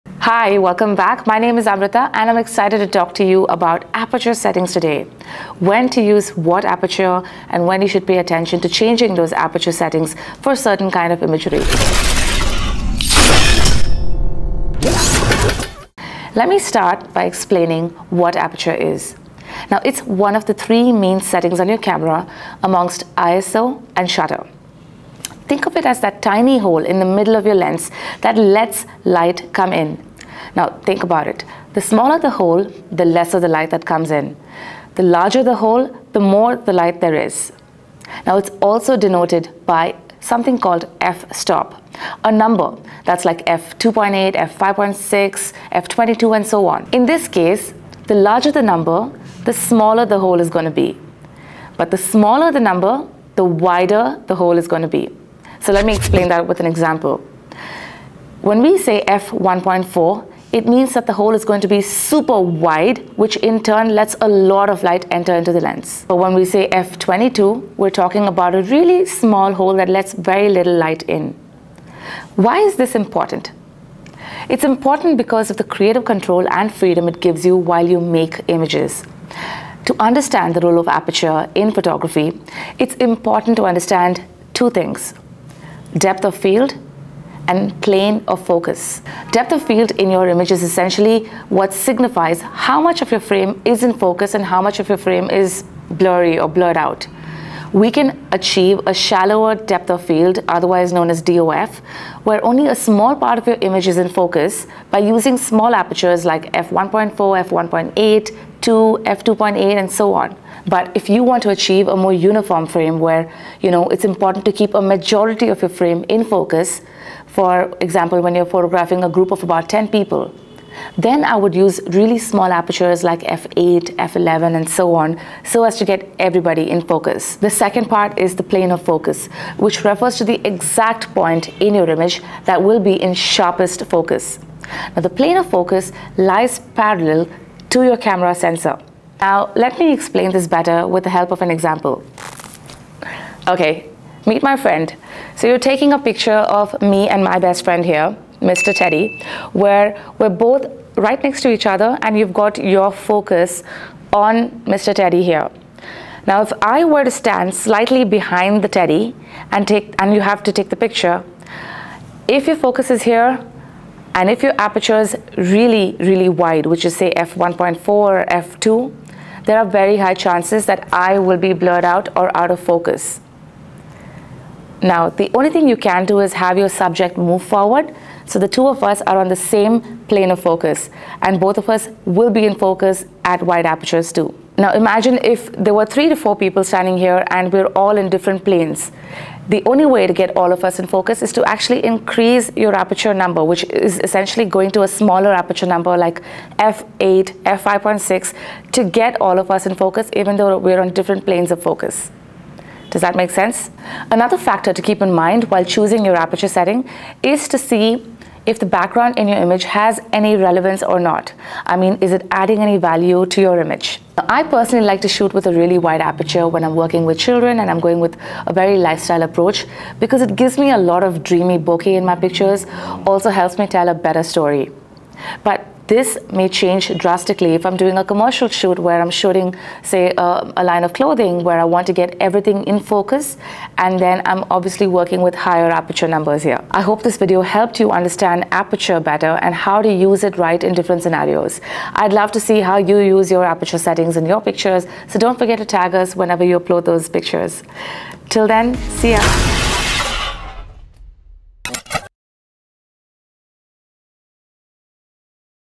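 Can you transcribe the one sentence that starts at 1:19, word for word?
To understand the role of aperture in photography, it's important to understand two things, depth of field and plane of focus.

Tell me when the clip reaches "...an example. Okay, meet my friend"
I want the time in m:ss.
2:21.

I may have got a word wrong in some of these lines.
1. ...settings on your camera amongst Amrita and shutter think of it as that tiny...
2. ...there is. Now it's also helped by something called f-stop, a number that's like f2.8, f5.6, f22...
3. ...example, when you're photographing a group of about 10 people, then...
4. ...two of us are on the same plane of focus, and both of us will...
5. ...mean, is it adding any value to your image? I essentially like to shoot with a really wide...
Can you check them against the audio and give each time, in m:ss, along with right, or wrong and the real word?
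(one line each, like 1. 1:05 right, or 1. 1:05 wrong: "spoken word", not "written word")
1. 0:21 wrong: "ISO", not "Amrita"
2. 0:37 wrong: "denoted", not "helped"
3. 1:57 right
4. 2:58 right
5. 3:31 wrong: "personally", not "essentially".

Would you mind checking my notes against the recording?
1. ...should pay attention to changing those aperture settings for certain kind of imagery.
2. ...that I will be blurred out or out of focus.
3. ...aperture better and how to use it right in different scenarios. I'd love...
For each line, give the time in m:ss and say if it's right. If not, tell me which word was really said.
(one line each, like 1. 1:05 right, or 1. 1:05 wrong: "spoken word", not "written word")
1. 0:07 right
2. 2:50 right
3. 3:58 right.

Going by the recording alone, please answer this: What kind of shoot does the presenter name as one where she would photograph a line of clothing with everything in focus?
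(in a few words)
commercial shoot.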